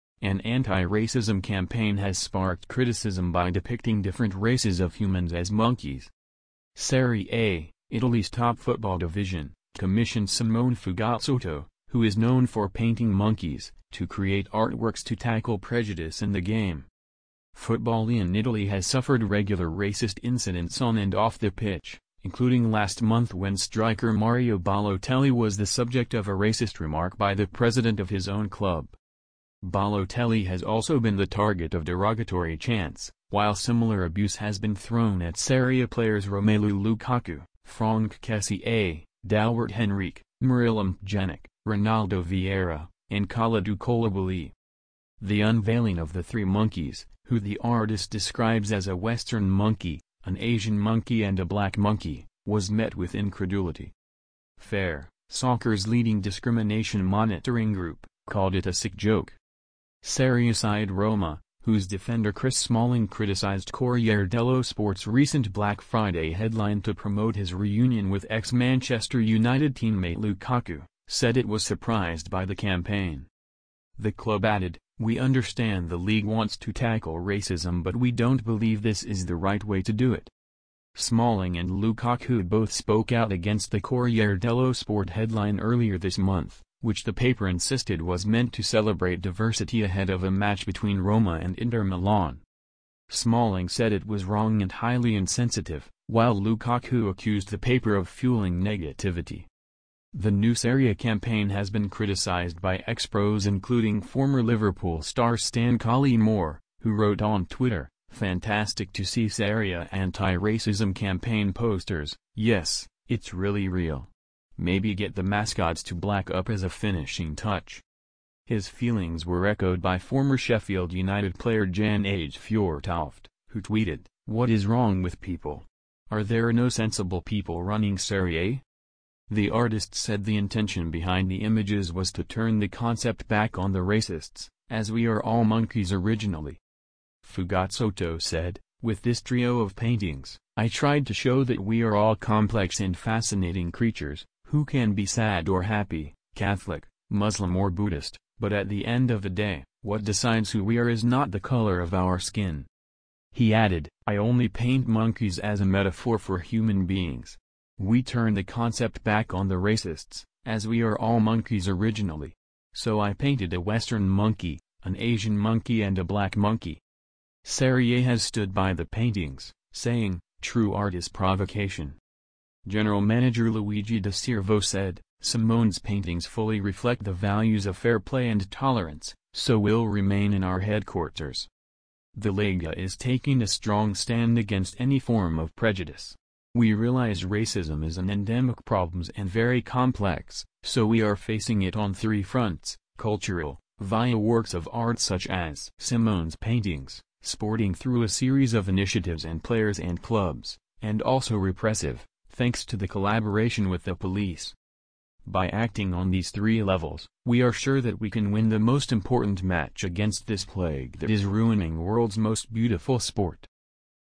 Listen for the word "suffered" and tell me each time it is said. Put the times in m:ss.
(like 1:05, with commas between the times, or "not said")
0:18.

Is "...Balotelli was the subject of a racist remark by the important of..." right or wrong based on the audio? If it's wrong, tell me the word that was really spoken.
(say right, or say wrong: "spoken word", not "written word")
wrong: "president", not "important".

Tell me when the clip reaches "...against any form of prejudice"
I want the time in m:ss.
3:04.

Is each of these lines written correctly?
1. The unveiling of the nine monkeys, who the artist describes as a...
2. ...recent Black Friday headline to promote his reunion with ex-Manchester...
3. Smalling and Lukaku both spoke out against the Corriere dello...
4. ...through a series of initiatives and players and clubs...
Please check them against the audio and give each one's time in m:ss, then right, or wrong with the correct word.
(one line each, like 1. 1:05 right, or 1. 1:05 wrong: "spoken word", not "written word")
1. 0:45 wrong: "three", not "nine"
2. 1:05 right
3. 1:20 right
4. 3:17 right.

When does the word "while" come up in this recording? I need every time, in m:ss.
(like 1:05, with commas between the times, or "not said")
0:33, 1:36.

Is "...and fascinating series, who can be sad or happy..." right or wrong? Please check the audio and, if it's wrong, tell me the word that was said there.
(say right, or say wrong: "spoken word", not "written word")
wrong: "creatures", not "series".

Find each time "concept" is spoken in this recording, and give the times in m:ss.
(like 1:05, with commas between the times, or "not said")
2:12, 2:38.